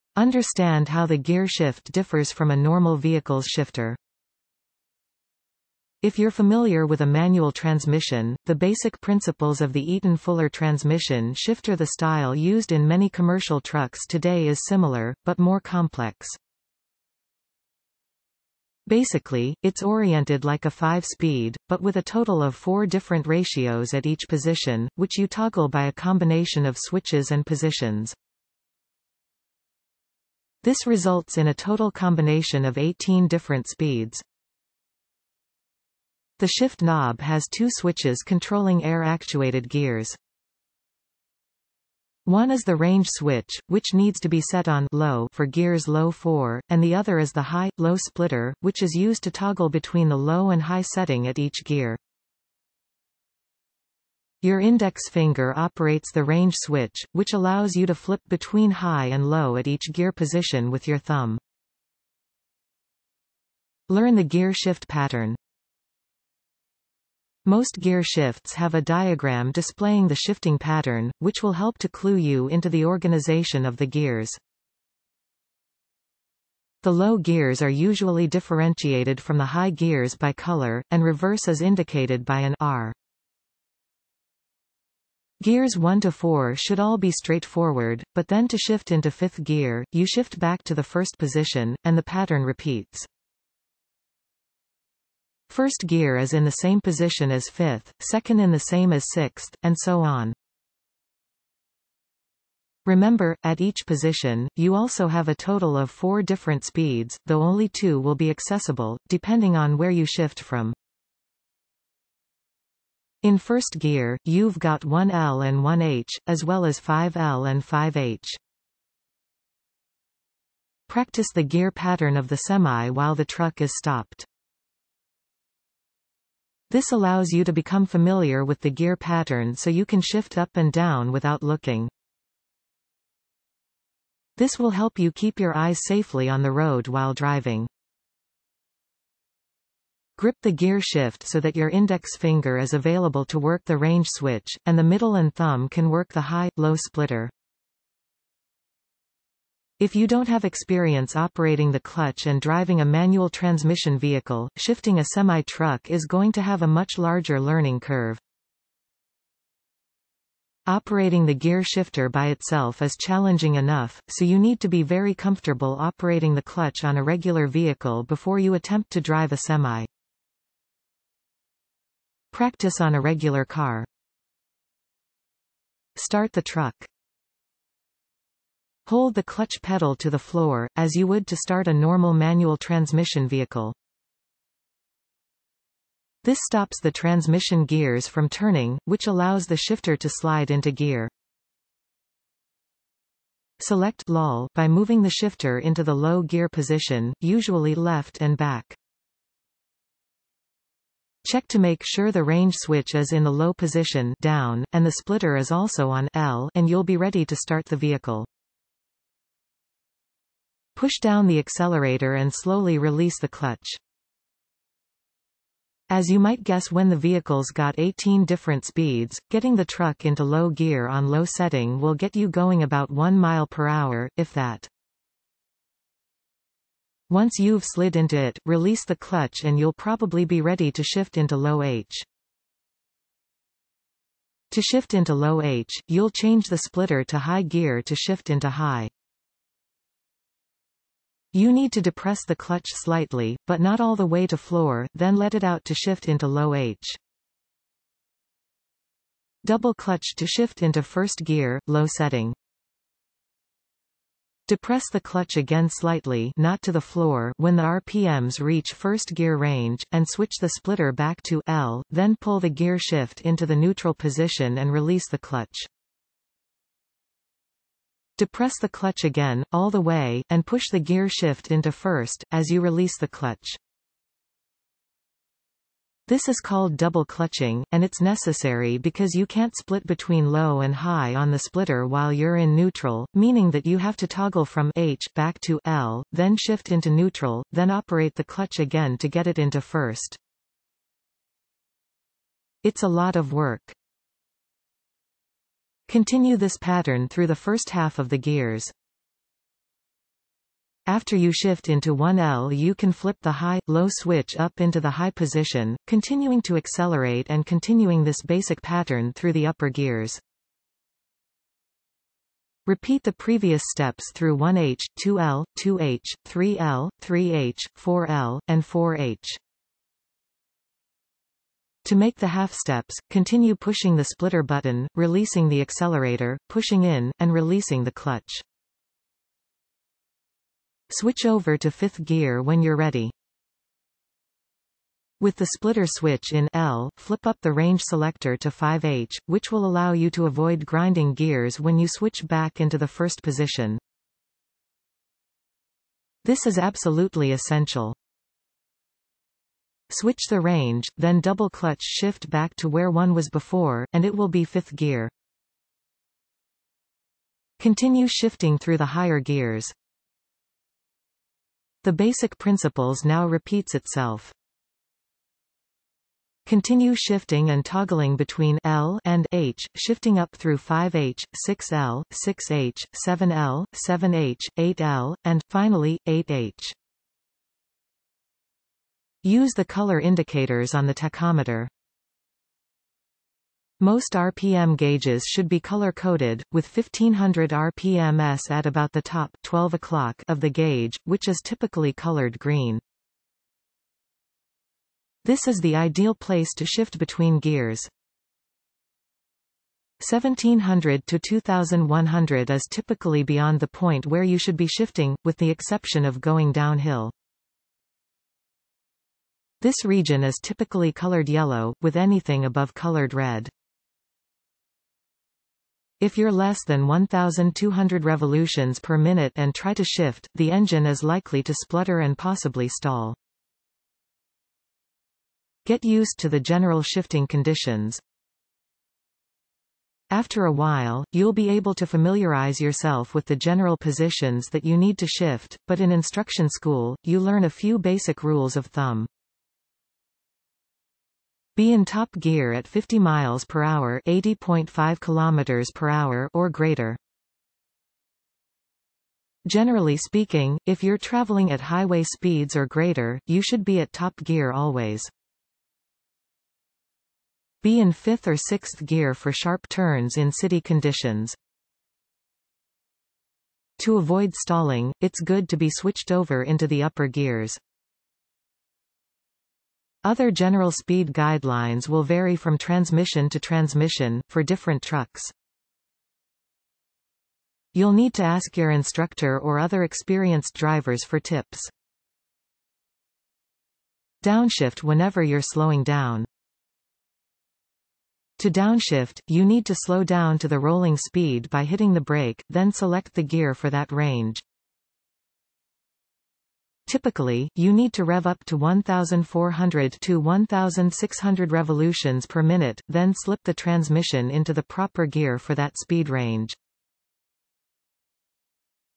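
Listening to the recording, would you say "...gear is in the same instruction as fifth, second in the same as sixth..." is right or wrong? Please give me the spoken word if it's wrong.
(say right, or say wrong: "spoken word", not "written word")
wrong: "position", not "instruction".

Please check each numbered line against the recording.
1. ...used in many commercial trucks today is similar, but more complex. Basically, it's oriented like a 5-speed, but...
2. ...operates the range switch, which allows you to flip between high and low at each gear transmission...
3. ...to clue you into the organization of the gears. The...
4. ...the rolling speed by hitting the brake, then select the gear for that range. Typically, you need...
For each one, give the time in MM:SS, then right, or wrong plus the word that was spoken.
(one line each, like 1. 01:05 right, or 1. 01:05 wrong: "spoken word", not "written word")
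1. 00:12 right
2. 00:55 wrong: "position", not "transmission"
3. 01:11 right
4. 08:10 right.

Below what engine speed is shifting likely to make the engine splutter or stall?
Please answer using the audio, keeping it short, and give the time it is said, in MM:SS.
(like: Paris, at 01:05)
1,200 RPM, at 06:56.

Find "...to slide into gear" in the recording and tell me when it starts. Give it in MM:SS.
03:09.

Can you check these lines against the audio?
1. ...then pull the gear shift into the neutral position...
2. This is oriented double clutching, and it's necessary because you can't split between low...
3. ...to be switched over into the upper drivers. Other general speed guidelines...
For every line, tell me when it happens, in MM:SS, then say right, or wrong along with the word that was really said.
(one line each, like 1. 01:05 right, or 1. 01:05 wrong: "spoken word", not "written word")
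1. 04:21 right
2. 04:36 wrong: "called", not "oriented"
3. 07:45 wrong: "gears", not "drivers".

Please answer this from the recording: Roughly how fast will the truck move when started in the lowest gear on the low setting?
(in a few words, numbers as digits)
1 mile per hour.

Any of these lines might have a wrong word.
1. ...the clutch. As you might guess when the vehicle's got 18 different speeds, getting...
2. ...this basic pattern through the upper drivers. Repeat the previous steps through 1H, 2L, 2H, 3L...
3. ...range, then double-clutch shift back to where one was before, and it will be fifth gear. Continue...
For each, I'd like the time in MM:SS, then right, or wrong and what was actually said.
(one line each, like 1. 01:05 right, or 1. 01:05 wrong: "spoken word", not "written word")
1. 03:33 right
2. 05:08 wrong: "gears", not "drivers"
3. 05:50 right.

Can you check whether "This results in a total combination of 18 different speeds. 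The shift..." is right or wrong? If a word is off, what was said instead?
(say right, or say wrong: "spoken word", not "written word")
right.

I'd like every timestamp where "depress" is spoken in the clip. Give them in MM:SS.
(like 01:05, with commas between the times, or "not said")
04:01, 04:14, 04:28.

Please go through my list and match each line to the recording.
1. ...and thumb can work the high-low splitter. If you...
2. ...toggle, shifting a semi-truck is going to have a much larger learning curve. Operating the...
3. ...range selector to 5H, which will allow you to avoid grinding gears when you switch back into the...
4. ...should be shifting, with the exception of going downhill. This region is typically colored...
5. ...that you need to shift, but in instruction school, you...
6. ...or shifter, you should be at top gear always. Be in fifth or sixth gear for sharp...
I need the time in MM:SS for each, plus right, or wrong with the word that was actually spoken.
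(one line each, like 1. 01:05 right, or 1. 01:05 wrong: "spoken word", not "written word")
1. 02:25 right
2. 02:33 wrong: "vehicle", not "toggle"
3. 05:37 right
4. 06:44 right
5. 07:14 right
6. 07:32 wrong: "greater", not "shifter".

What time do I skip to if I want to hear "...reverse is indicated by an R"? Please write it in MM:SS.
01:21.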